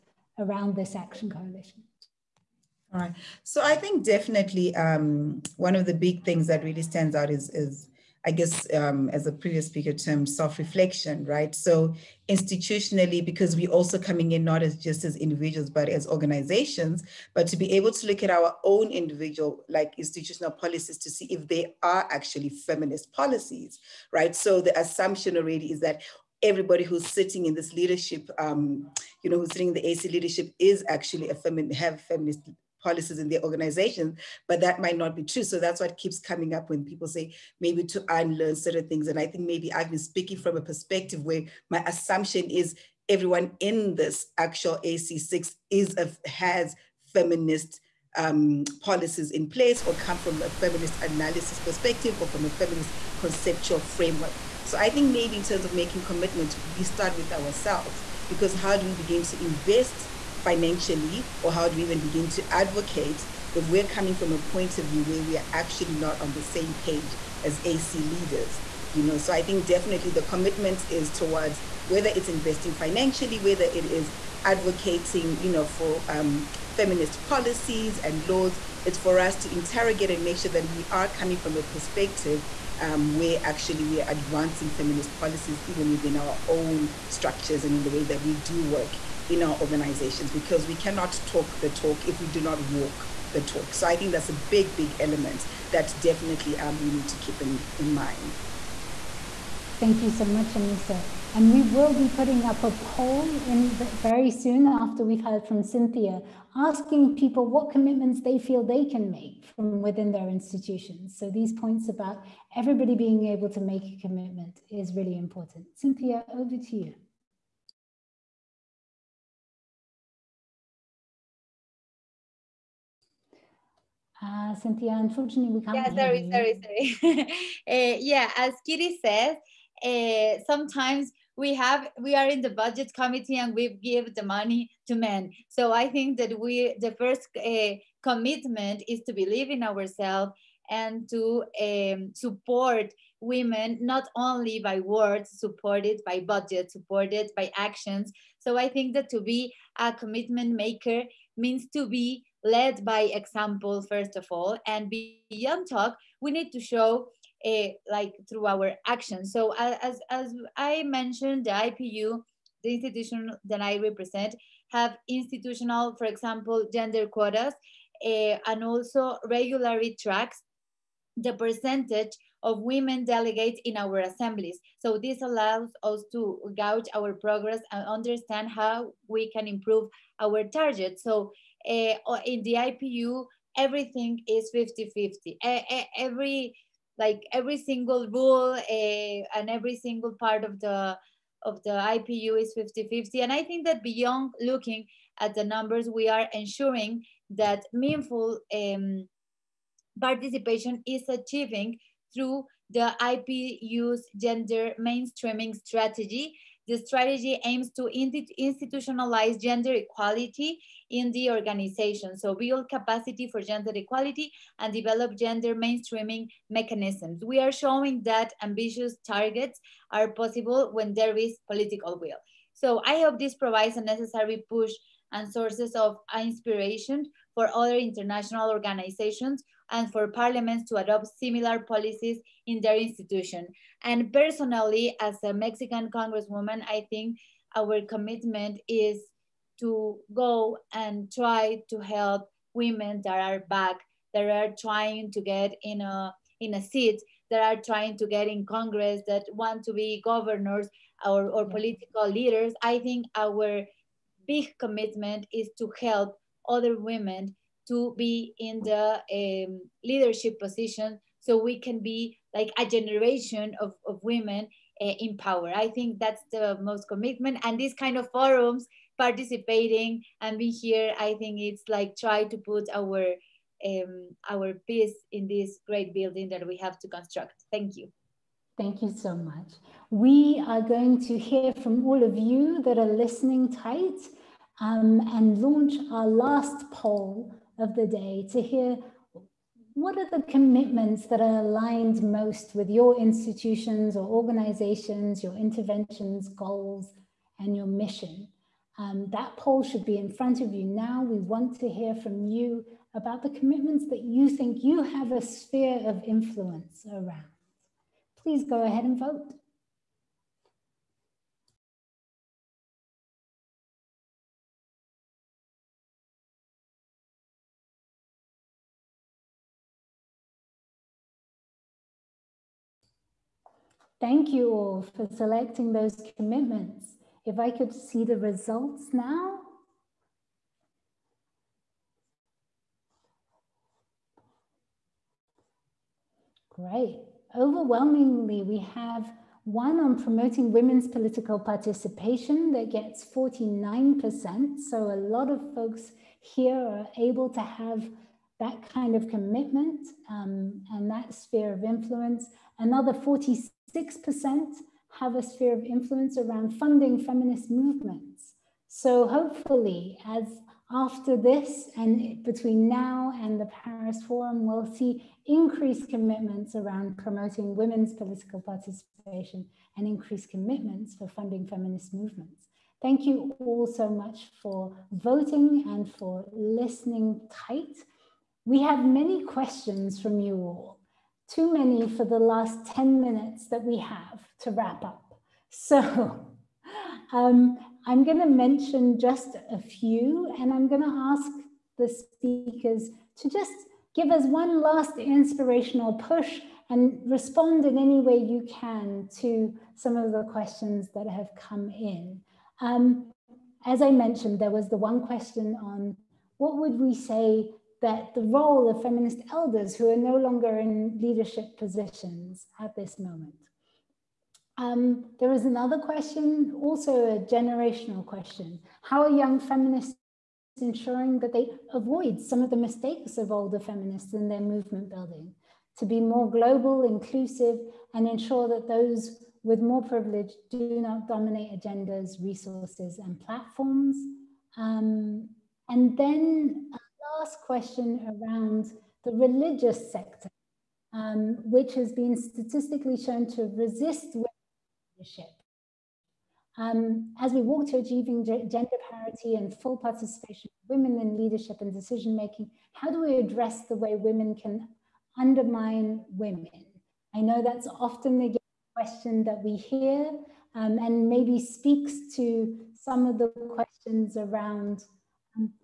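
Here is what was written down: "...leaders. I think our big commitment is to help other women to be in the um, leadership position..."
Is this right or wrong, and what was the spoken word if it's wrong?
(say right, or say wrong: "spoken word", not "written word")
right.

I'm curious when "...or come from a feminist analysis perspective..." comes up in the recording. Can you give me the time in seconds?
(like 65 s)
49 s.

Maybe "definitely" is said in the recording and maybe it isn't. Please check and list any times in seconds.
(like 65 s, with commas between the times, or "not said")
4 s, 69 s, 95 s.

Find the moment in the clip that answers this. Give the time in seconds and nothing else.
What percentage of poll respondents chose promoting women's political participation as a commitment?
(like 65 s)
343 s.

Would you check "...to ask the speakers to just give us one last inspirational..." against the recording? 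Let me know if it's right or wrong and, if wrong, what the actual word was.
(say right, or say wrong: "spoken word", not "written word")
right.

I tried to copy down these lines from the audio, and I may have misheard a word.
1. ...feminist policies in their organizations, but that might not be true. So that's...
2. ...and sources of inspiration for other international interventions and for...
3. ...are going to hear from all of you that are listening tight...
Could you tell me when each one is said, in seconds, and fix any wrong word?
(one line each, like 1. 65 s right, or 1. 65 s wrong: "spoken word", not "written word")
1. 32 s right
2. 225 s wrong: "organizations", not "interventions"
3. 280 s right.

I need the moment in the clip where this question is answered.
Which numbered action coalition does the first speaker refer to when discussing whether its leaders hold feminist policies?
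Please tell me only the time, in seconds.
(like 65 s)
44 s.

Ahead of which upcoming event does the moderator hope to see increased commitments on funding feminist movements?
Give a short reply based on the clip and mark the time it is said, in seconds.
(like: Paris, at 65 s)
Paris Forum, at 363 s.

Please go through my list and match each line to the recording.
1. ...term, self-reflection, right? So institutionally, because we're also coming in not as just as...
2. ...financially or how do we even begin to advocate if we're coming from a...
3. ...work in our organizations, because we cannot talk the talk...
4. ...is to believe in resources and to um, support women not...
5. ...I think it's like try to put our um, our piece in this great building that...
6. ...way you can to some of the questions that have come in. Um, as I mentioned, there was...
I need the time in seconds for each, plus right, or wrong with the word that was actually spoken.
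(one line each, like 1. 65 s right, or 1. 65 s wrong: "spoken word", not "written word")
1. 9 s right
2. 60 s right
3. 88 s right
4. 138 s wrong: "ourselves", not "resources"
5. 270 s right
6. 398 s right.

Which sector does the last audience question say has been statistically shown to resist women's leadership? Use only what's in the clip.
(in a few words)
religious sector.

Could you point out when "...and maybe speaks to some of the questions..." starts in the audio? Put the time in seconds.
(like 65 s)
460 s.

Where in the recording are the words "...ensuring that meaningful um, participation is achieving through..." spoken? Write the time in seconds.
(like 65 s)
196 s.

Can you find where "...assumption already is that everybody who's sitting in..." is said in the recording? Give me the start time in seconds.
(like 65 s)
24 s.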